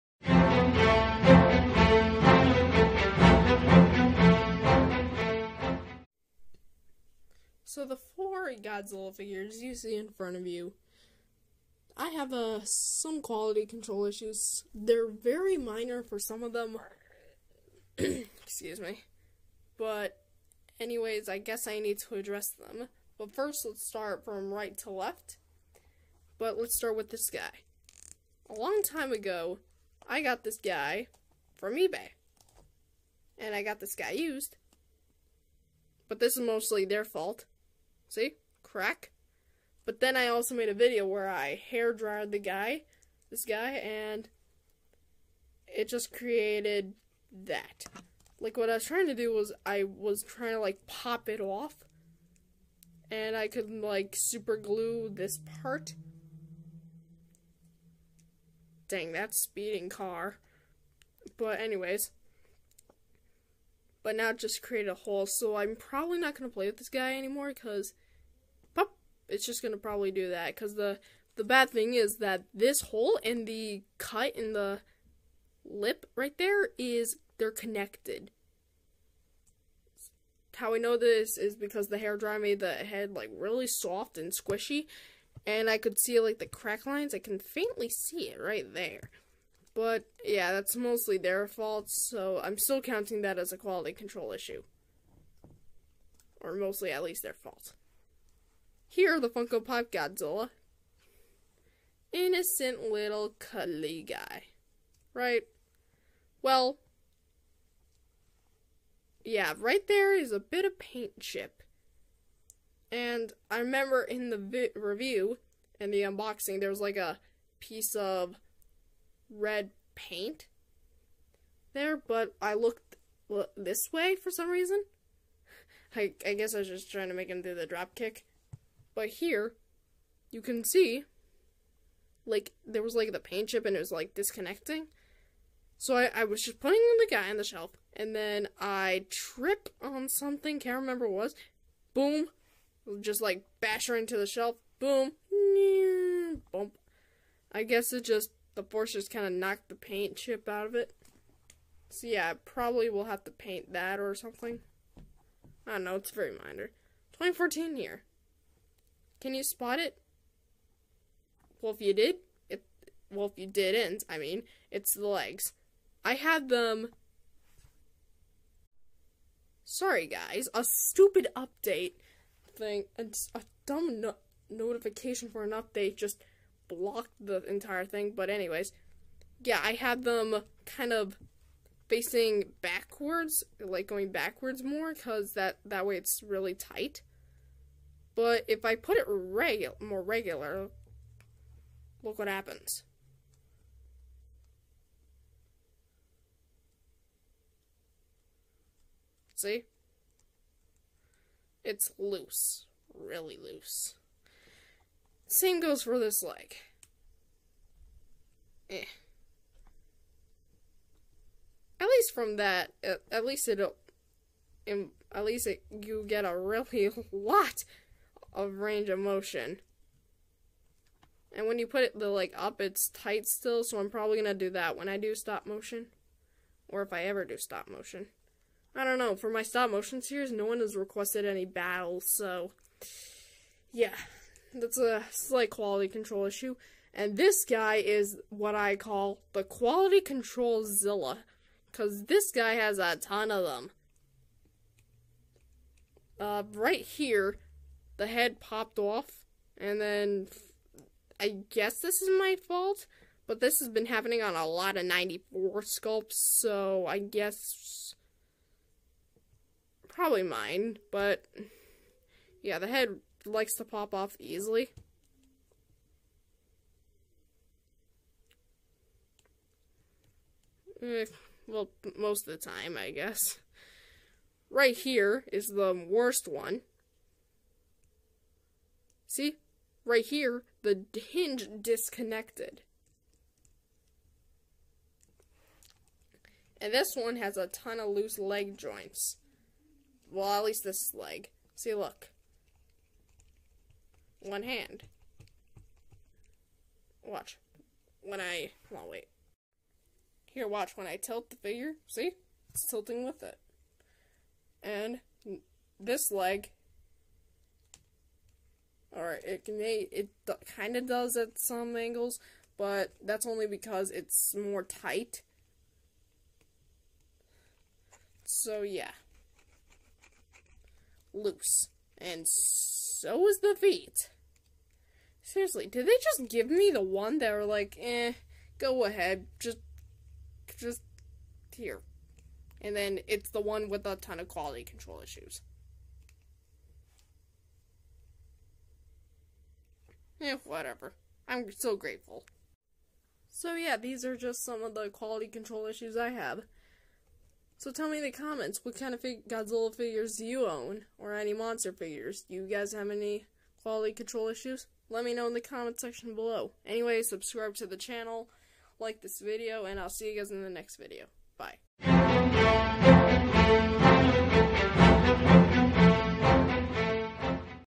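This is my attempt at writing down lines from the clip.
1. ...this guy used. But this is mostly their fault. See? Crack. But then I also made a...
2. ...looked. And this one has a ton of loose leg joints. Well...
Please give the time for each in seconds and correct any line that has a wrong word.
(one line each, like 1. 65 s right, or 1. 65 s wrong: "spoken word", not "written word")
1. 33 s right
2. 281 s wrong: "disconnected", not "looked".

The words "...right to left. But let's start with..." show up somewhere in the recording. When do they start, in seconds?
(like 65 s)
24 s.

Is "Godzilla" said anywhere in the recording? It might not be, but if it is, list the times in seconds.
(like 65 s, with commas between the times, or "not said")
8 s, 99 s, 349 s.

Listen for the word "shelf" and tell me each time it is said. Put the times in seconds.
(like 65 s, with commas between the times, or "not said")
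137 s, 144 s.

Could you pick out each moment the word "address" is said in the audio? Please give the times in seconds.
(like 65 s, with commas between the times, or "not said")
22 s.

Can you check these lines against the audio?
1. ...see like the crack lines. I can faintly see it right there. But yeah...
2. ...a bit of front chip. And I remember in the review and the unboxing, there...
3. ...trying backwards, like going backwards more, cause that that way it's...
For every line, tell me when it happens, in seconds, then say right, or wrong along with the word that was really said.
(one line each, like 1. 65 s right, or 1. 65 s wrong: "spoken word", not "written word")
1. 85 s right
2. 110 s wrong: "paint", not "front"
3. 181 s wrong: "facing", not "trying".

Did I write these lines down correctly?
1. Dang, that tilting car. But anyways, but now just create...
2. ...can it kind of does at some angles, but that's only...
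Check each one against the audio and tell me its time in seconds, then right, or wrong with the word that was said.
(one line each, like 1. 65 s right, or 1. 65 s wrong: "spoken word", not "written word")
1. 58 s wrong: "speeding", not "tilting"
2. 309 s right.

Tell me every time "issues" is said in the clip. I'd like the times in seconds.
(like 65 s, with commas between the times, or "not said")
14 s, 94 s, 236 s, 335 s, 345 s, 354 s.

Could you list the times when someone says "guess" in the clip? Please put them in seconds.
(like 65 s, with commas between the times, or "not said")
21 s, 126 s, 147 s, 251 s, 256 s, 272 s.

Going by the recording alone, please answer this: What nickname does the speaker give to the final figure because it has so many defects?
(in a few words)
Quality control Zilla.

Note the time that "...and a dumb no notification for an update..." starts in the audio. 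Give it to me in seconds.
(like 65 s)
172 s.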